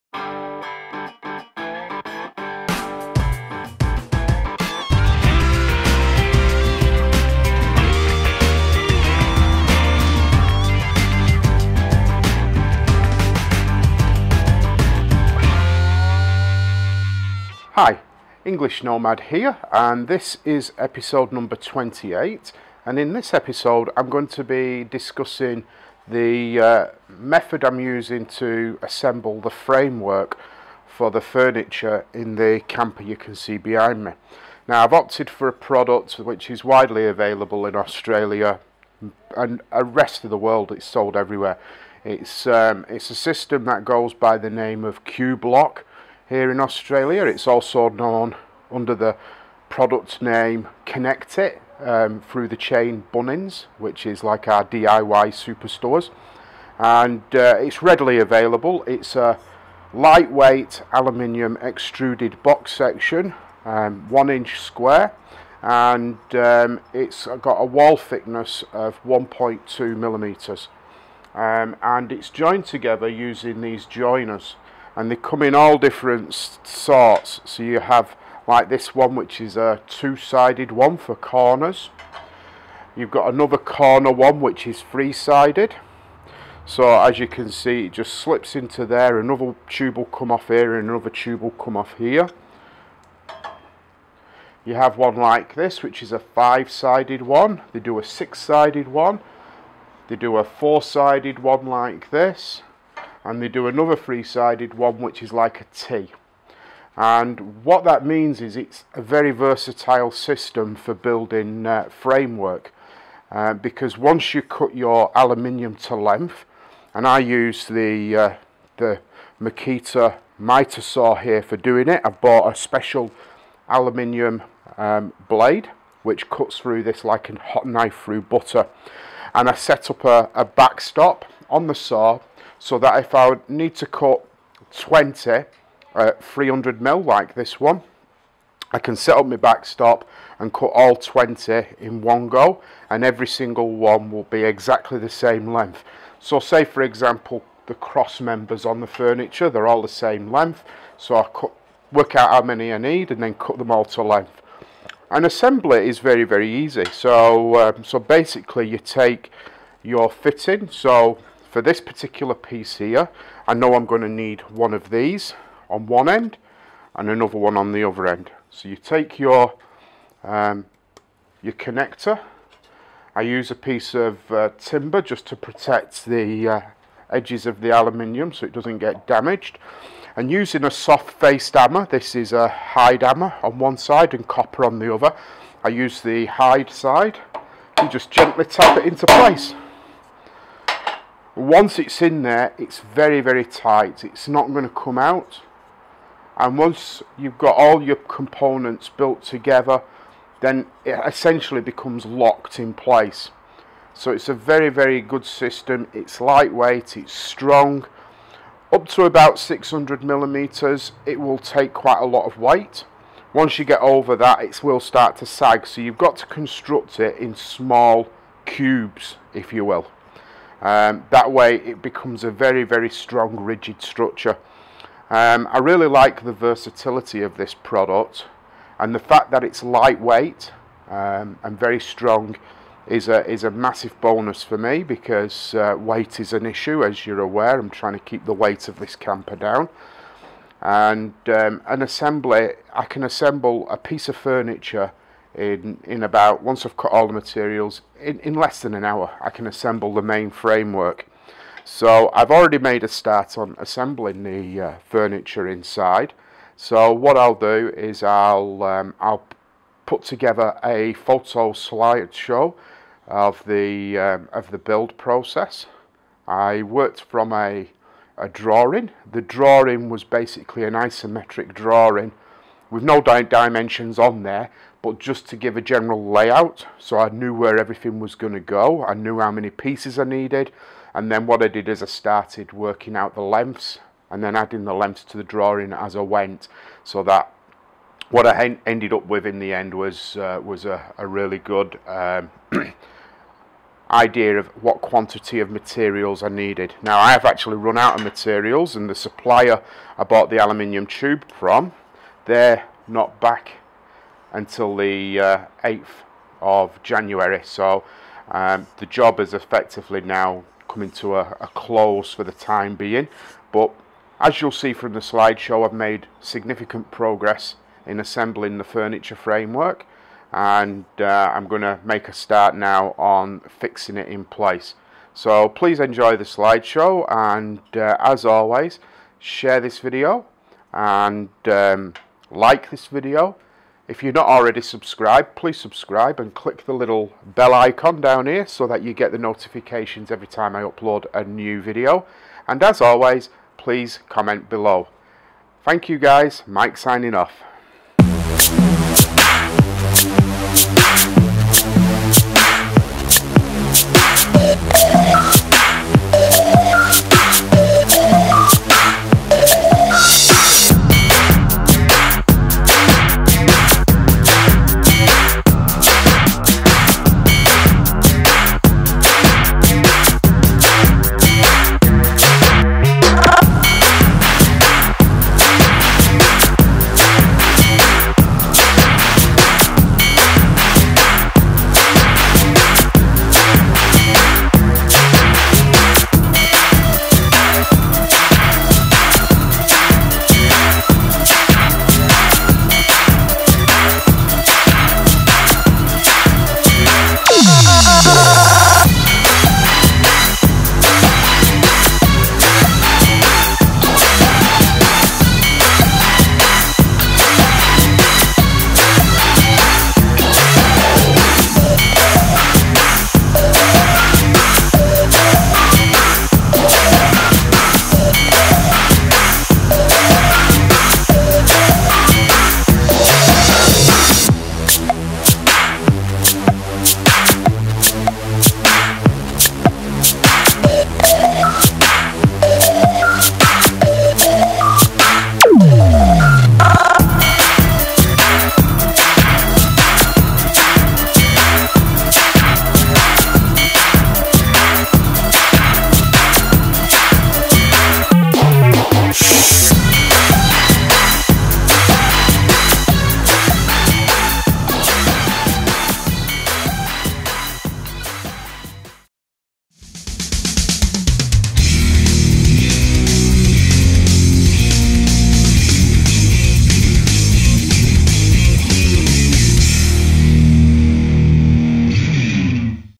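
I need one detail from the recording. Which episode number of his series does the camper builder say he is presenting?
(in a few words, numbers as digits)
28.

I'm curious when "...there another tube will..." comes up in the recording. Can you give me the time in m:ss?
1:28.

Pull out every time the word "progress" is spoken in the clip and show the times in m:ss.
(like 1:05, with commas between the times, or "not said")
5:16.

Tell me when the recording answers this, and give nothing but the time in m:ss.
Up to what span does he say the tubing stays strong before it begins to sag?
3:29.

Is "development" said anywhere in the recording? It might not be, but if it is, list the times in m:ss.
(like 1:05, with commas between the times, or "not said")
not said.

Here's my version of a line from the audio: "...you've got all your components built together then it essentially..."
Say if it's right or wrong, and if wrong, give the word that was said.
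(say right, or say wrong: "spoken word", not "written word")
right.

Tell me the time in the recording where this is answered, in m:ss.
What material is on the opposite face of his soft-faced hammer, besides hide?
3:04.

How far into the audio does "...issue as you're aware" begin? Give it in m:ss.
3:56.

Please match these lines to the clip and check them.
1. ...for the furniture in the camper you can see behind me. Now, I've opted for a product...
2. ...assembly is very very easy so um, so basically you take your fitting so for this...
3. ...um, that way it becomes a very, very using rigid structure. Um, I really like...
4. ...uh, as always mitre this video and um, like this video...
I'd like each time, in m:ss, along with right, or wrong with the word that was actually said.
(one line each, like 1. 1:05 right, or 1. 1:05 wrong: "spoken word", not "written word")
1. 0:30 right
2. 2:35 right
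3. 3:40 wrong: "strong", not "using"
4. 5:27 wrong: "share", not "mitre".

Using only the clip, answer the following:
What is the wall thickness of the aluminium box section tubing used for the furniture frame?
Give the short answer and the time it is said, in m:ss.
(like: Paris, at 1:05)
1.2 millimeters, at 1:09.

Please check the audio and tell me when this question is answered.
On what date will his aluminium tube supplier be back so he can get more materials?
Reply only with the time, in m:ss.
5:05.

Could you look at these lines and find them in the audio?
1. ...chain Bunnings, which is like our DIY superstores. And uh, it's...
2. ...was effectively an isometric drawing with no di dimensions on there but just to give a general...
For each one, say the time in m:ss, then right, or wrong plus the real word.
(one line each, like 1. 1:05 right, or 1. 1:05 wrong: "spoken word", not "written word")
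1. 0:52 right
2. 4:29 wrong: "basically", not "effectively".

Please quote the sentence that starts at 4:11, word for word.
So I've already made a start on assembling the uh, furniture inside.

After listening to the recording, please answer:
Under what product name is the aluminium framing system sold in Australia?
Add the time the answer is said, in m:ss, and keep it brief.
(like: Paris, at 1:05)
Qubelok, at 0:45.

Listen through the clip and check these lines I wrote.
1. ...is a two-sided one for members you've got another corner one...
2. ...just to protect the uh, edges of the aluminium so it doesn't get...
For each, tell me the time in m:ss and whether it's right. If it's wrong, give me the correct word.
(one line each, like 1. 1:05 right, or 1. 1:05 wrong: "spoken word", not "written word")
1. 1:19 wrong: "corners", not "members"
2. 2:55 right.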